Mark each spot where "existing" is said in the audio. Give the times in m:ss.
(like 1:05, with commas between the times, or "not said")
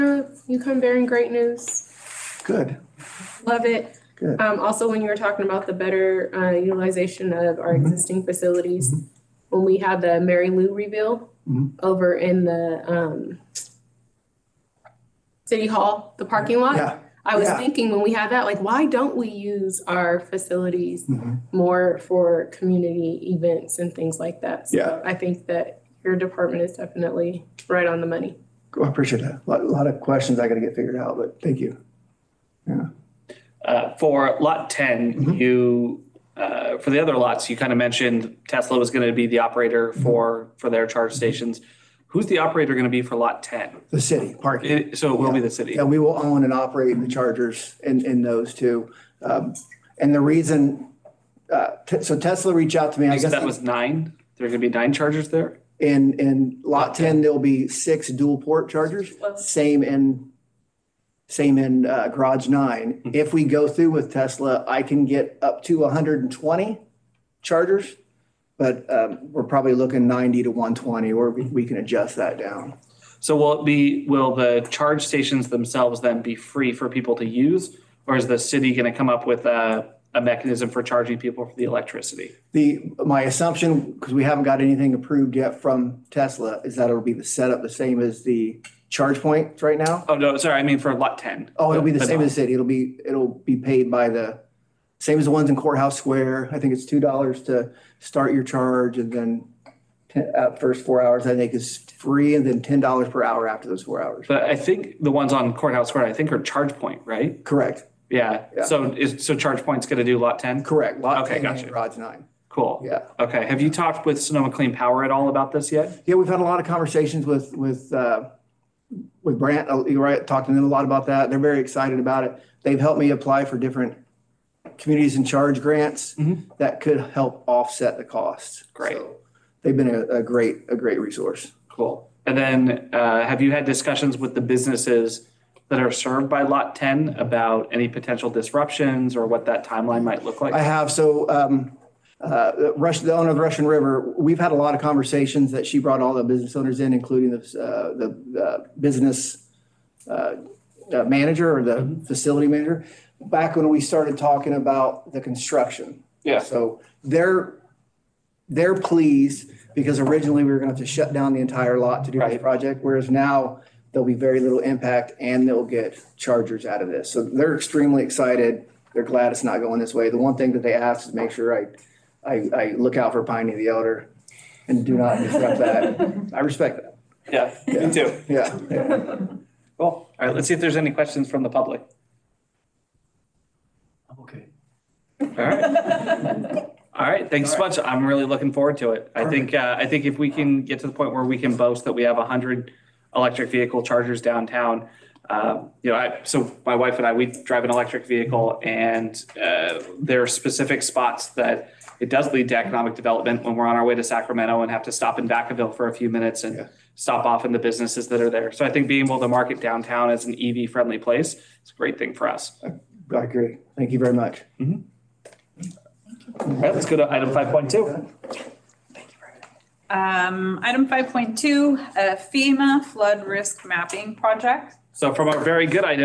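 0:07.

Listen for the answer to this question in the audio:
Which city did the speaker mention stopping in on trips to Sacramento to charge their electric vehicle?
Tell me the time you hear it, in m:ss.
3:25.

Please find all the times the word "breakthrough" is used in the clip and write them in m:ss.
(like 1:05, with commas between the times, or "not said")
not said.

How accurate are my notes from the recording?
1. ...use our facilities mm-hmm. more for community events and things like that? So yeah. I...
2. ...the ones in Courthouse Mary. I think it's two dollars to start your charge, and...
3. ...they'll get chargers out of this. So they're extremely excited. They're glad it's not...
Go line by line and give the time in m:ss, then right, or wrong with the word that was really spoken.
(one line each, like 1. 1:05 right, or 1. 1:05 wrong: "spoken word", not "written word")
1. 0:19 right
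2. 1:35 wrong: "Square", not "Mary"
3. 2:45 right.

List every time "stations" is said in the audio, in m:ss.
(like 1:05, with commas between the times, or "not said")
0:41, 1:15.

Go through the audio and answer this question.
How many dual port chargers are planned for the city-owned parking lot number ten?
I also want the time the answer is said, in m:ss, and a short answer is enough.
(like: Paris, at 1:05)
6, at 0:57.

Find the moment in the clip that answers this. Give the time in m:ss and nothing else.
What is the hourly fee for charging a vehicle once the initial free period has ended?
1:42.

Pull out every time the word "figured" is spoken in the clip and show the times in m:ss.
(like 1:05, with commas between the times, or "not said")
0:30.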